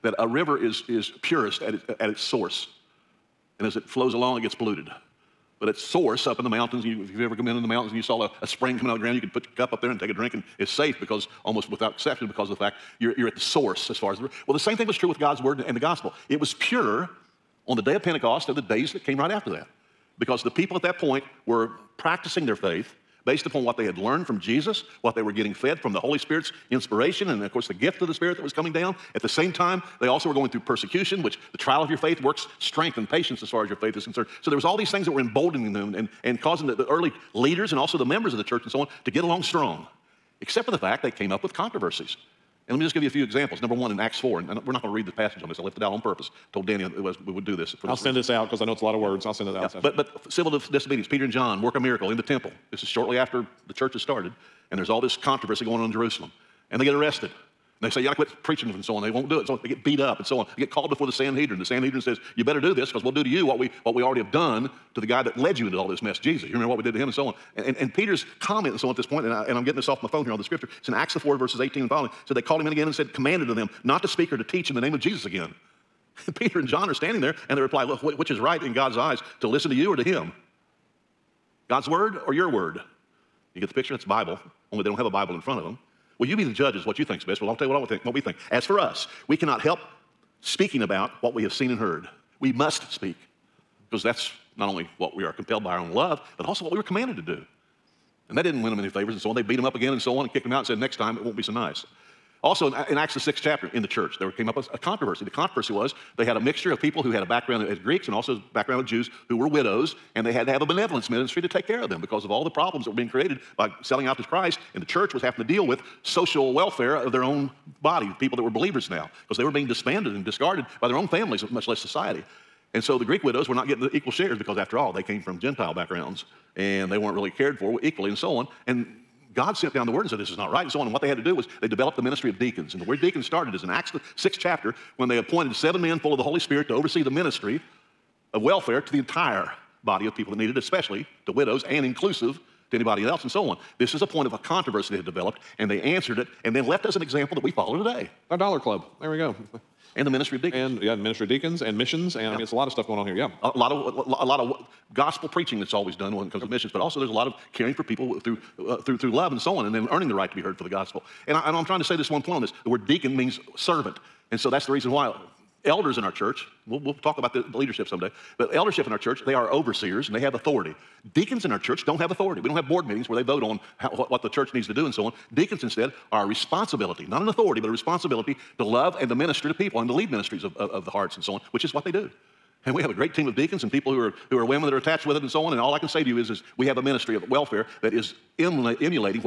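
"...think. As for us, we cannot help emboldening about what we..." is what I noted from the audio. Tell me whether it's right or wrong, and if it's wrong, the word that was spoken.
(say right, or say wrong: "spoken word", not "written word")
wrong: "speaking", not "emboldening".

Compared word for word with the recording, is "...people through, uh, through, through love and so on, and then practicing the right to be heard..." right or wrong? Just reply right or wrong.
wrong.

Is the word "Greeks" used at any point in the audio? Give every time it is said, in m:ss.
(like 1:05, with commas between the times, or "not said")
1:47, 2:03.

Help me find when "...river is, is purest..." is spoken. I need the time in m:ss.
0:00.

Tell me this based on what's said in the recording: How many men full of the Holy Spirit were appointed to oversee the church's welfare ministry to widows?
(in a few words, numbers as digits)
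7.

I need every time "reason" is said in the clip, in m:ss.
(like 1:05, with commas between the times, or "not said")
0:48, 2:44.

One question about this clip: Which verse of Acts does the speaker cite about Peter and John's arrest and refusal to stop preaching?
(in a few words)
Acts 4:18.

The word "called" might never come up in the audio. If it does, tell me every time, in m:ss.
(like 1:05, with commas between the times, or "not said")
1:00, 1:12.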